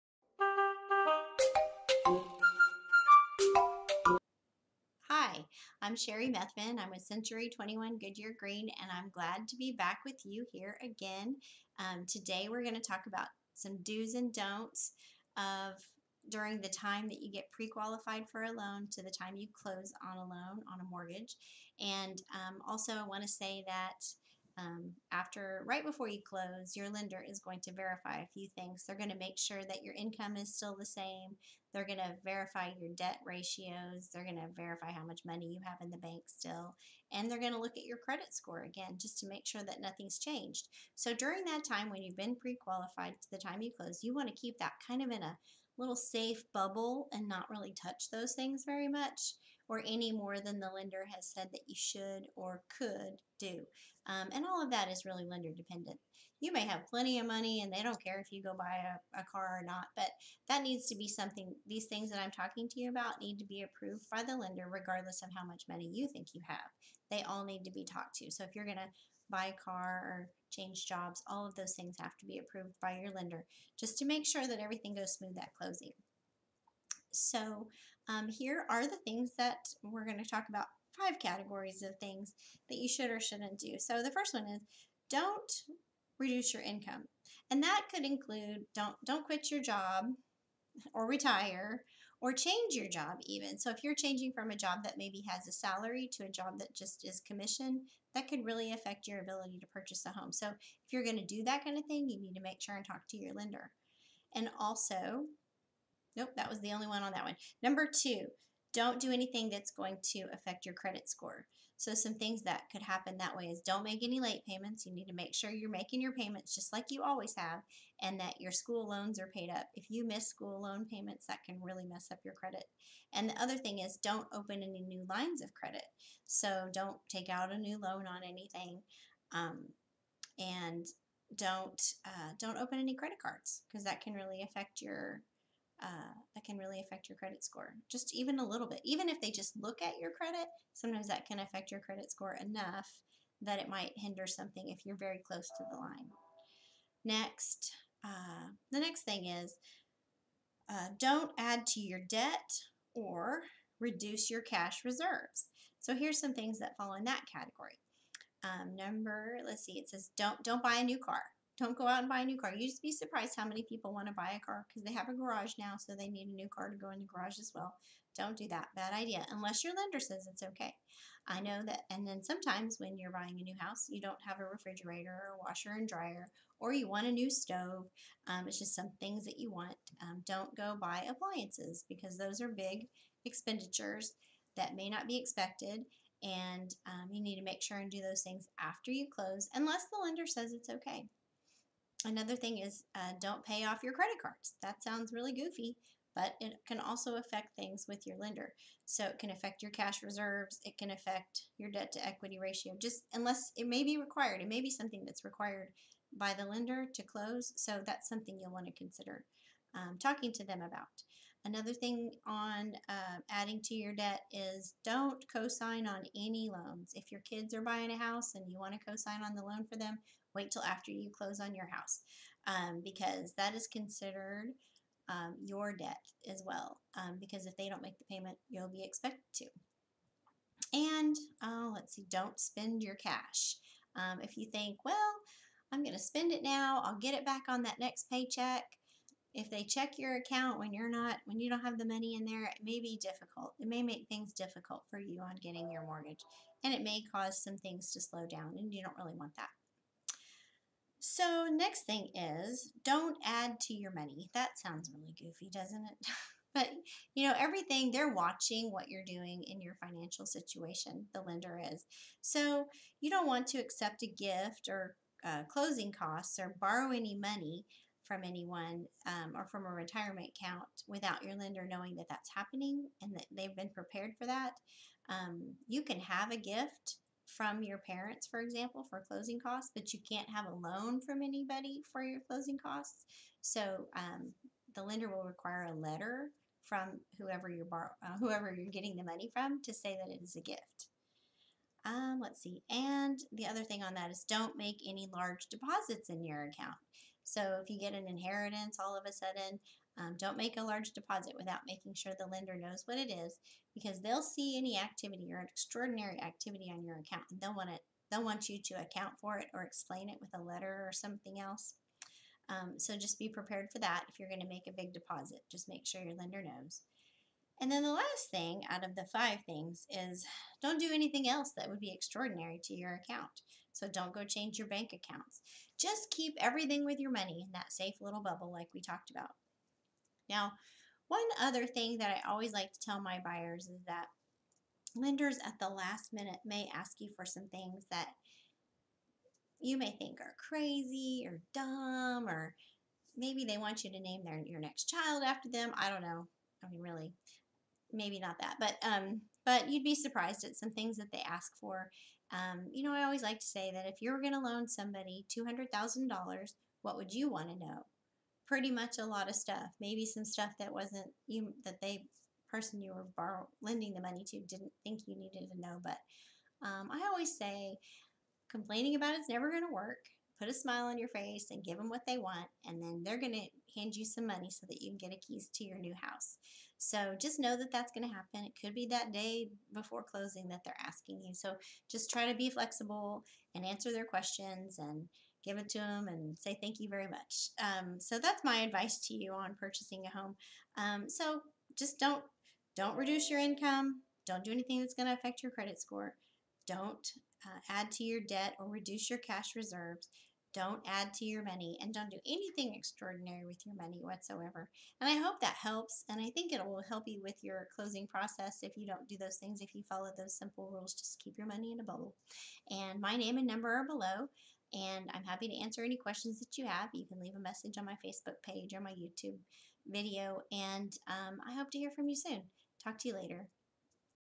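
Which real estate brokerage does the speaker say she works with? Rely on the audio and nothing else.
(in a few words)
Century 21 Goodyear Green.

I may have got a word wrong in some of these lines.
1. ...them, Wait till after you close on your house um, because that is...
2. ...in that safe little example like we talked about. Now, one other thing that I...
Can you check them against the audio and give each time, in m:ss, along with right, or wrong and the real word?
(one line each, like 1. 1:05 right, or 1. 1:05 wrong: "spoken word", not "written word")
1. 3:39 right
2. 5:27 wrong: "bubble", not "example".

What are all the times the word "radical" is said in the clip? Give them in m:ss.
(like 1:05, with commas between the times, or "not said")
not said.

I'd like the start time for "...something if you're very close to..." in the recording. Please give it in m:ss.
2:24.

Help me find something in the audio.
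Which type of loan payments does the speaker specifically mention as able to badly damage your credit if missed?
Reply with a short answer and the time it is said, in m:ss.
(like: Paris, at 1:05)
school loans, at 2:00.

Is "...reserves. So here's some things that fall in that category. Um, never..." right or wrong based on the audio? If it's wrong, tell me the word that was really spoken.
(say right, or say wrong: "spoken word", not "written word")
wrong: "number", not "never".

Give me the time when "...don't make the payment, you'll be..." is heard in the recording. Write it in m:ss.
3:47.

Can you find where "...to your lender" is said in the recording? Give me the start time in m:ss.
1:43.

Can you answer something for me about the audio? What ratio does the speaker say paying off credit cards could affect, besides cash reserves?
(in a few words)
debt to equity ratio.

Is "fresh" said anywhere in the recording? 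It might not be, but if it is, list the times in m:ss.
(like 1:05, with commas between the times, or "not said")
not said.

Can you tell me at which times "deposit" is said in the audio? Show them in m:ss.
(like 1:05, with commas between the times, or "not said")
4:55, 5:00, 5:14.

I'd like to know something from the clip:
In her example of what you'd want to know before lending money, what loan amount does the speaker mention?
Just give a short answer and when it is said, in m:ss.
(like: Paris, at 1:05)
$200,000, at 5:55.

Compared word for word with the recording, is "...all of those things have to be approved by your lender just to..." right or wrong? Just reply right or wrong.
right.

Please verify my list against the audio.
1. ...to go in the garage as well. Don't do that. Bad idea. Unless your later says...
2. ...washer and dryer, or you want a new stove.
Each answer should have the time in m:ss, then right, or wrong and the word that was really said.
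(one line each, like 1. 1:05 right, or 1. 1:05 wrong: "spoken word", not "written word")
1. 2:46 wrong: "lender", not "later"
2. 2:55 right.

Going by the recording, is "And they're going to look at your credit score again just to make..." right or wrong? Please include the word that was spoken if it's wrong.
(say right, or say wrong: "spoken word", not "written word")
right.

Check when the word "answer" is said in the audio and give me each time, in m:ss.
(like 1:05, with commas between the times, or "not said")
6:23, 6:55.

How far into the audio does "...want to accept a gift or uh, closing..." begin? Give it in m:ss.
4:23.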